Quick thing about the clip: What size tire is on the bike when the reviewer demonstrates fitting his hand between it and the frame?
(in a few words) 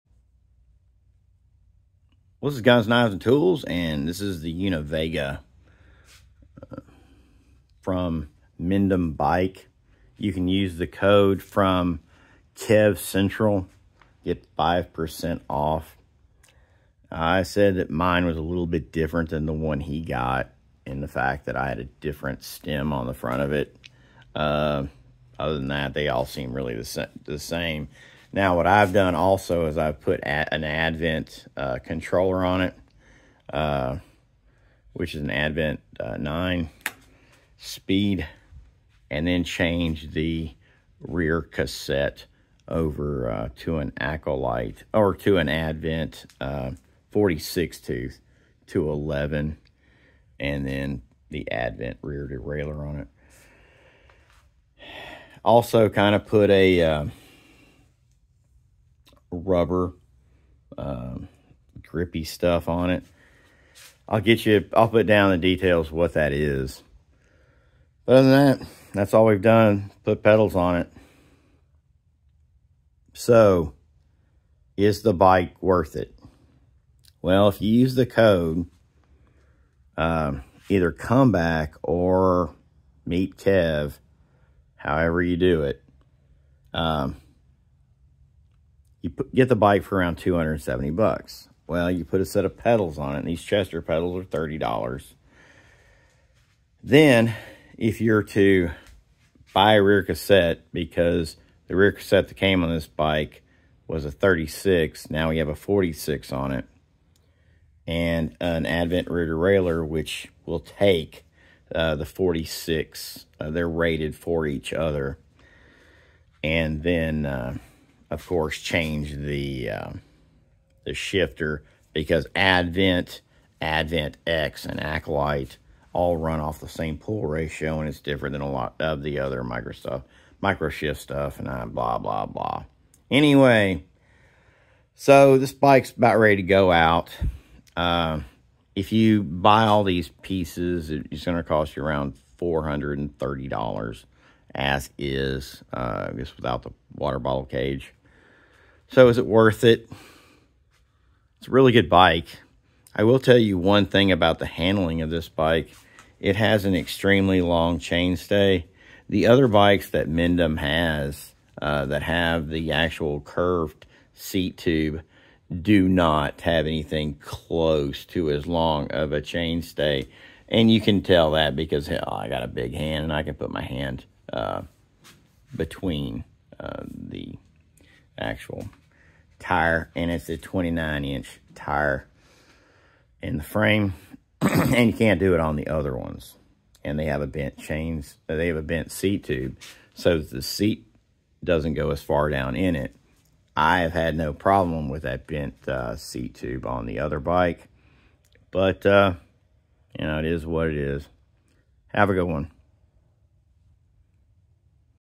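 29-inch.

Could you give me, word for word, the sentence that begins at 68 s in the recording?
But other than that, that's all we've done, put pedals on it.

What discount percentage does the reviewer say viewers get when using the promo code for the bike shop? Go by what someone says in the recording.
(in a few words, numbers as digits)
5%.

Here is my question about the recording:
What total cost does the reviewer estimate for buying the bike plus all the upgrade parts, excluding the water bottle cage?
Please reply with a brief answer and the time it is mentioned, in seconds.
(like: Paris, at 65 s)
$430, at 142 s.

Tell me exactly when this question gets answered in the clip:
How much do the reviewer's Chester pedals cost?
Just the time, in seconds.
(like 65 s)
94 s.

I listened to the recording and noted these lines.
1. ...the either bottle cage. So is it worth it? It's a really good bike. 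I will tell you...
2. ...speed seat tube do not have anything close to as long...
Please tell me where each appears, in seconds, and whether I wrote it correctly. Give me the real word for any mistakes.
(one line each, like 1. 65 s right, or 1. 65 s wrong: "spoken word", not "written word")
1. 146 s wrong: "water", not "either"
2. 163 s wrong: "curved", not "speed".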